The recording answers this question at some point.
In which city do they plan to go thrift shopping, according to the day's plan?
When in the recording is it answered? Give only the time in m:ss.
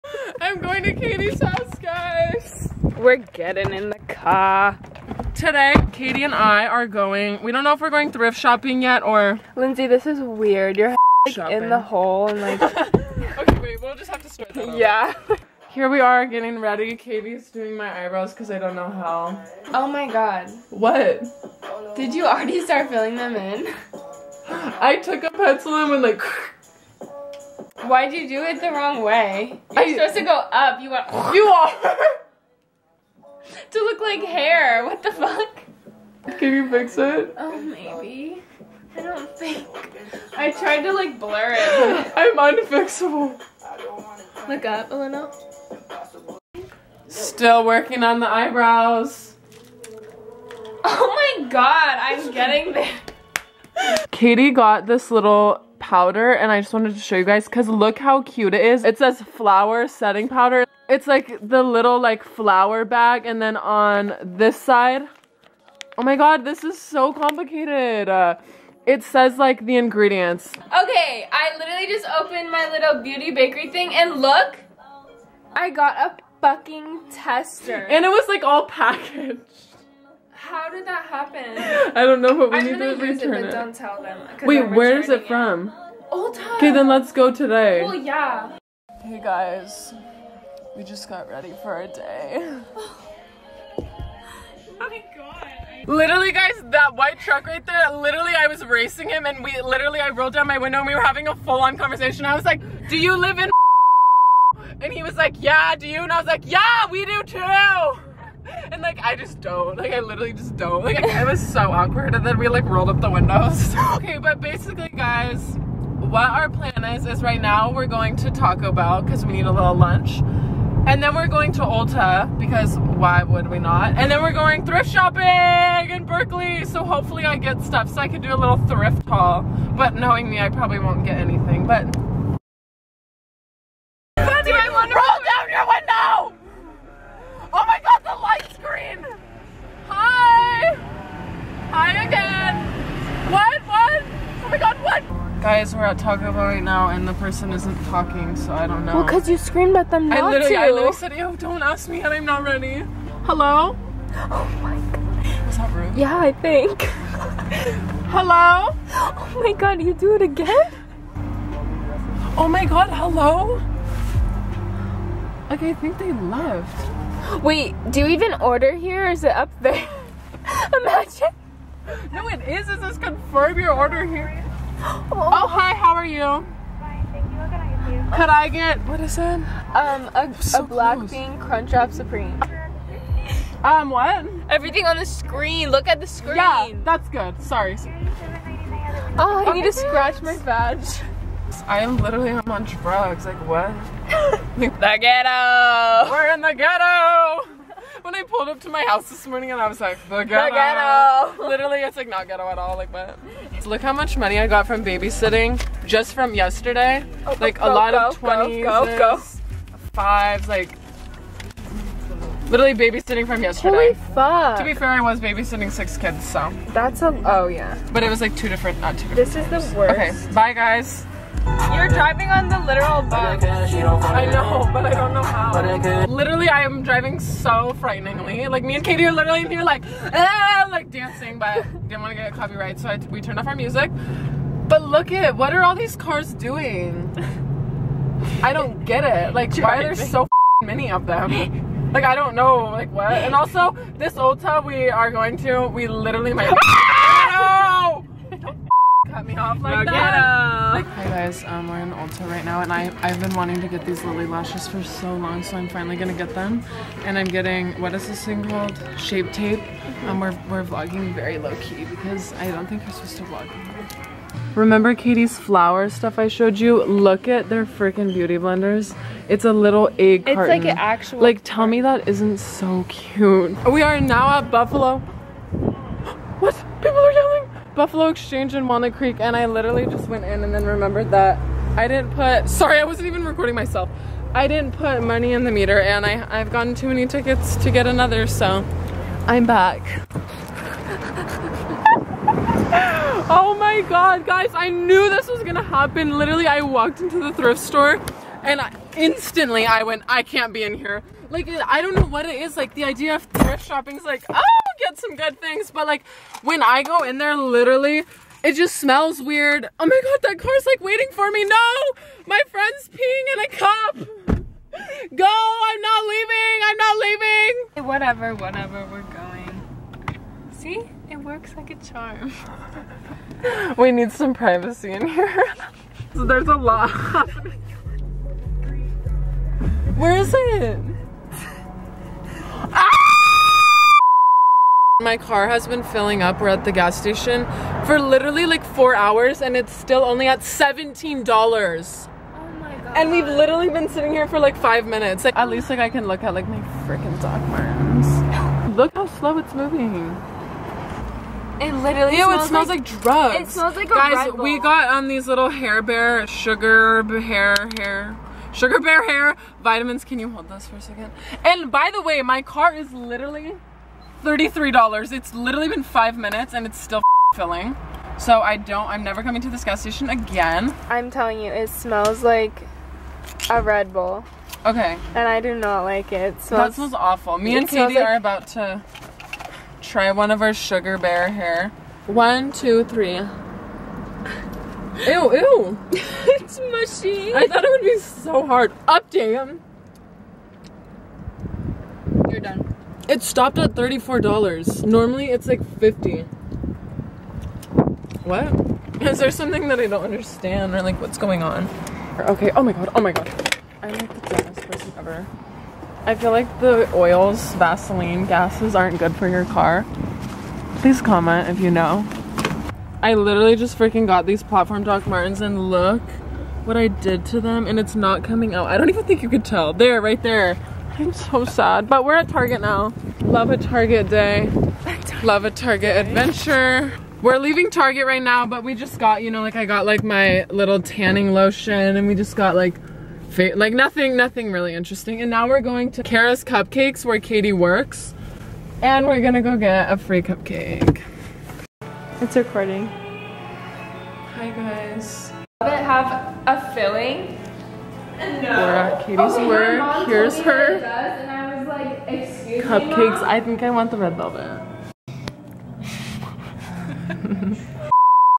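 2:06.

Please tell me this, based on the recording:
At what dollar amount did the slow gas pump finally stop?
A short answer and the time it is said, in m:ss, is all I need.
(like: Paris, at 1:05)
$34, at 6:33.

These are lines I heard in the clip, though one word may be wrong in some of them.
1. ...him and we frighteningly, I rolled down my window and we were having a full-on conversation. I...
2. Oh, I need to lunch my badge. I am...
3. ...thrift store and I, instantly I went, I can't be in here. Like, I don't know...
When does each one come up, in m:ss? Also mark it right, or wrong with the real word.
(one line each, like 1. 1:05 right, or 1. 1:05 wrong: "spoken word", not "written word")
1. 1:39 wrong: "literally", not "frighteningly"
2. 3:09 wrong: "scratch", not "lunch"
3. 4:57 right.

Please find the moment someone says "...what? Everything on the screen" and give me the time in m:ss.
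3:03.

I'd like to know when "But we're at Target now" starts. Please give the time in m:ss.
7:01.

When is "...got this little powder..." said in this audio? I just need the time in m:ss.
0:54.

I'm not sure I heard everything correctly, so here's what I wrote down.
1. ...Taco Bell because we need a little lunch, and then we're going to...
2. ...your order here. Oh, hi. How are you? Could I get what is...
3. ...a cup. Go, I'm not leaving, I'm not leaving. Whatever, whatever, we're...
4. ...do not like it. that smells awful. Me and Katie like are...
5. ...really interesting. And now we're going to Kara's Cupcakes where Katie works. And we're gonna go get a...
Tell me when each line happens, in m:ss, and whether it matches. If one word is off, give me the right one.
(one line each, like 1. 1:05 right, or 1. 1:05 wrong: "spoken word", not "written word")
1. 1:58 right
2. 2:53 right
3. 5:13 right
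4. 6:15 right
5. 7:14 right.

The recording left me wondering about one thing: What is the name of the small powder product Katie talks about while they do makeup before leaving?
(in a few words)
Flower setting powder.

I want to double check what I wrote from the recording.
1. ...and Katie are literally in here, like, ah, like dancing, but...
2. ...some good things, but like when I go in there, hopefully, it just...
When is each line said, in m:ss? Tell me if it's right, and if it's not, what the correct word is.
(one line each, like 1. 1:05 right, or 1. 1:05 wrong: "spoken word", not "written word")
1. 3:48 right
2. 5:04 wrong: "literally", not "hopefully".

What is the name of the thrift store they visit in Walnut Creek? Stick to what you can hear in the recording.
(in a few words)
Buffalo Exchange.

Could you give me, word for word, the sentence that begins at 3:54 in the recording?
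But look at what are all these cars doing?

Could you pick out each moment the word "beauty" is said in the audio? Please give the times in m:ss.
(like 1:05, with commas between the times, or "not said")
1:13, 4:28.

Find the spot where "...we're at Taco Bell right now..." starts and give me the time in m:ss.
2:25.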